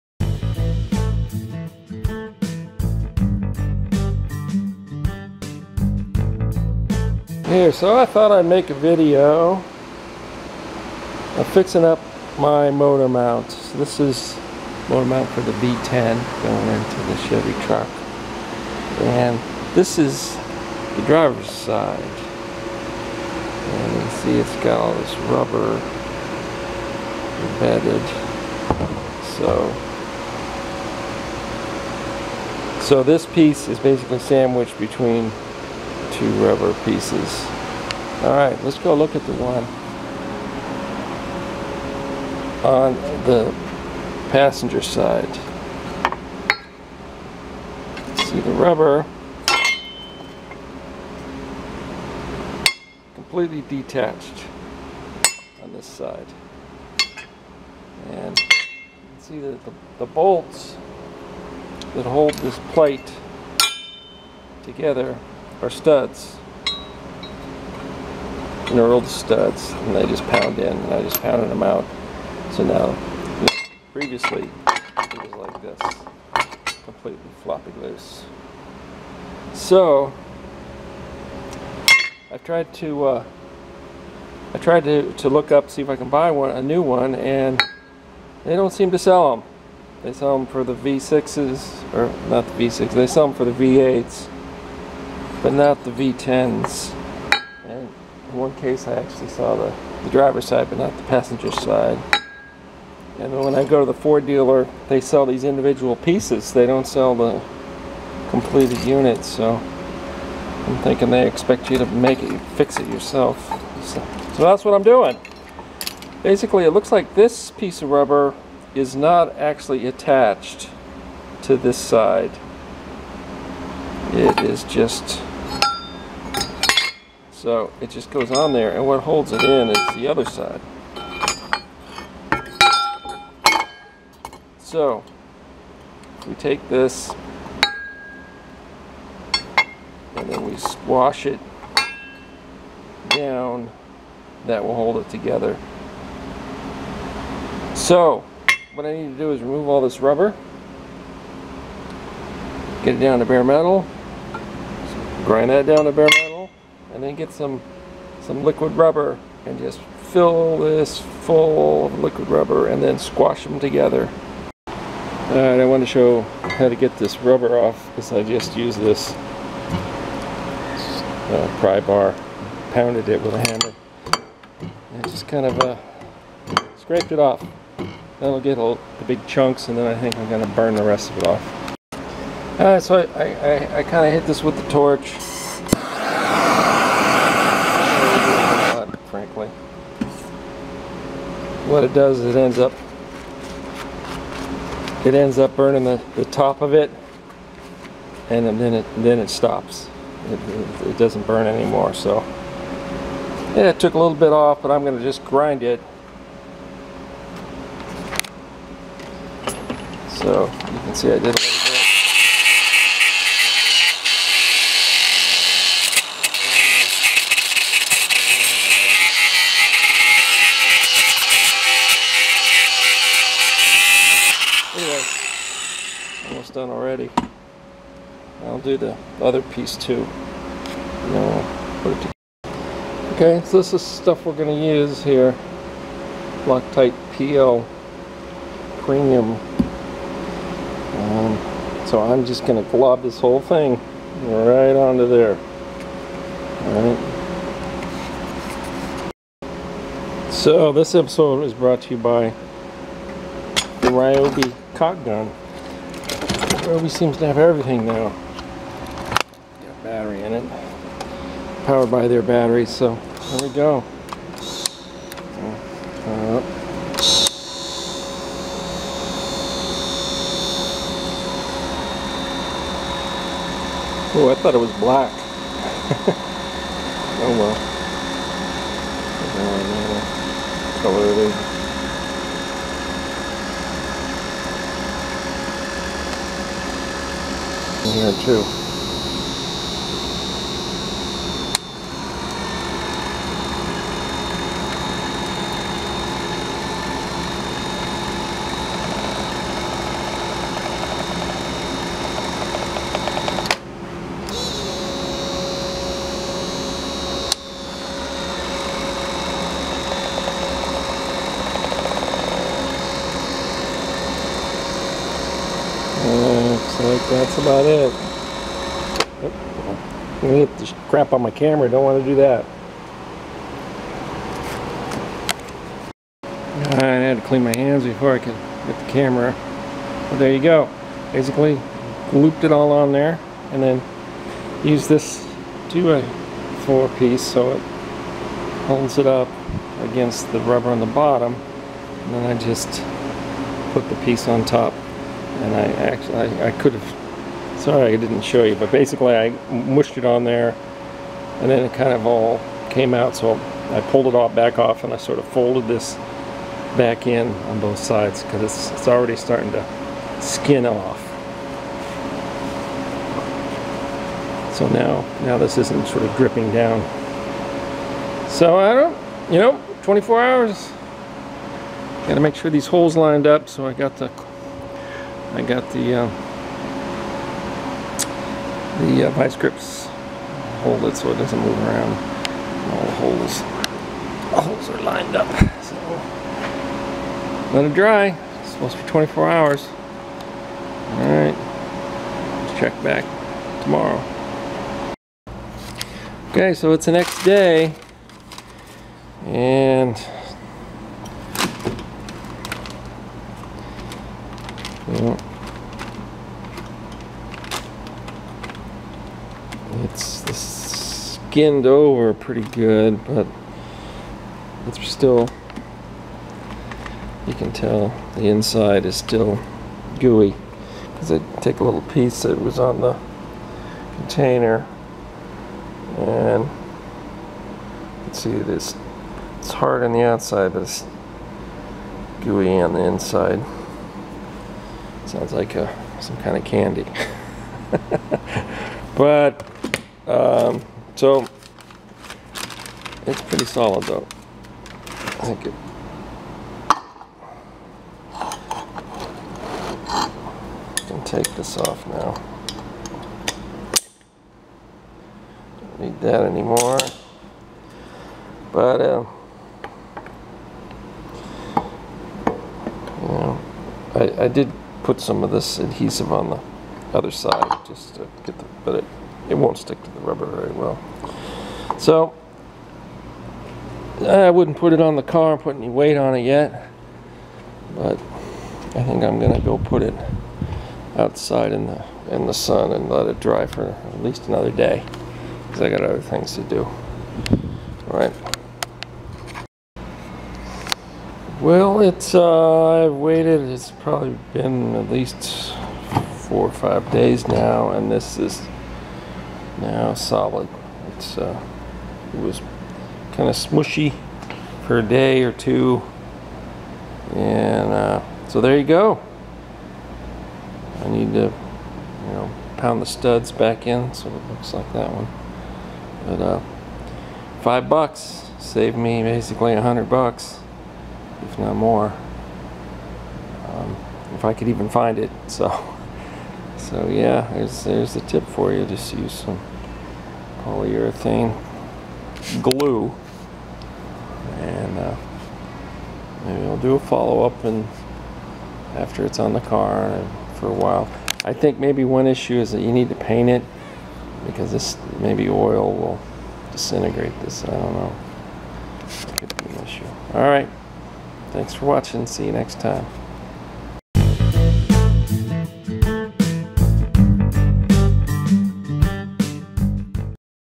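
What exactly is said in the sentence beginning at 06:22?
All the holes all holes are lined up.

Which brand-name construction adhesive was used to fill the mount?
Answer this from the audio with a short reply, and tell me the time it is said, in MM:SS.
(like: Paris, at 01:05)
Loctite PL Premium, at 03:56.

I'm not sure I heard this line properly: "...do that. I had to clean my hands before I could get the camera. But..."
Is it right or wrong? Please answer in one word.
right.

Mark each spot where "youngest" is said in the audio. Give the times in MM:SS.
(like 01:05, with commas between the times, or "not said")
not said.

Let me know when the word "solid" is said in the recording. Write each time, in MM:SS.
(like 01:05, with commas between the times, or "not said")
07:23, 08:19.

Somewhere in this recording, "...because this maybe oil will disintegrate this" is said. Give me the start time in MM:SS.
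09:04.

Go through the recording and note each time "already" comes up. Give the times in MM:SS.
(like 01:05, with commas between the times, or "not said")
03:46, 05:58.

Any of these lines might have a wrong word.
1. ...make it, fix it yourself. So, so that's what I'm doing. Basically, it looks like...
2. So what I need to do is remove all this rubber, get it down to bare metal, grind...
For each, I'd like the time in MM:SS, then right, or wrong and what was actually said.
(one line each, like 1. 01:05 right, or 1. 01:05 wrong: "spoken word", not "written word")
1. 01:51 right
2. 02:27 right.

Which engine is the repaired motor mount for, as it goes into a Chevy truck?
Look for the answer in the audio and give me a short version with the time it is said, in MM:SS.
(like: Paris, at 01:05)
V10, at 00:15.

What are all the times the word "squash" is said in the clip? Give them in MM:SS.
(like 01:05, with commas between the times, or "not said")
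02:20, 02:42.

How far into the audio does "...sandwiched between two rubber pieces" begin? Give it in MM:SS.
00:34.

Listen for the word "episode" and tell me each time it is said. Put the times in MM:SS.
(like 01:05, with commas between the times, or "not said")
04:10.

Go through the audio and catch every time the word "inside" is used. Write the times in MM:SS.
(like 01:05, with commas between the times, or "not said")
06:58, 07:12.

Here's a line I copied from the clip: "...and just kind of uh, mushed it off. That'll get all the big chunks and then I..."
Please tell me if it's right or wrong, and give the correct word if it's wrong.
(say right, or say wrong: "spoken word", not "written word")
wrong: "scraped", not "mushed".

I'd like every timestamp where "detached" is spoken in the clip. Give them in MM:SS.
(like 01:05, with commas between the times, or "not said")
00:53.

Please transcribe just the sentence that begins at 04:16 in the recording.
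Ryobi seems to have everything now.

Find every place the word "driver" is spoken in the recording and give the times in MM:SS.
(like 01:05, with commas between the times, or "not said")
00:21, 01:40.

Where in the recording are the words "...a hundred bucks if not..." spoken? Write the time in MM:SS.
08:39.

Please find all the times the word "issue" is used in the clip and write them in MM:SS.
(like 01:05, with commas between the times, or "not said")
09:02, 09:09.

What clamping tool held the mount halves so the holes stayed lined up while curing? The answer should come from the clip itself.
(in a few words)
vice grips.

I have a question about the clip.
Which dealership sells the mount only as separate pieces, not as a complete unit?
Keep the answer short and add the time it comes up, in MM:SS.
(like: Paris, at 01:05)
Ford, at 01:43.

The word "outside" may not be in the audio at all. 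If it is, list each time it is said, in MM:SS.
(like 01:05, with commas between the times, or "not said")
07:10, 08:00.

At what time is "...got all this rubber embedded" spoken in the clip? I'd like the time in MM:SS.
00:24.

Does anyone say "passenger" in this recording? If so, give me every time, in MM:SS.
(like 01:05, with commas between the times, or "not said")
00:44, 01:41.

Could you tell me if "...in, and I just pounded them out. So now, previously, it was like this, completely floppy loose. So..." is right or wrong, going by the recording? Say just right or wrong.
right.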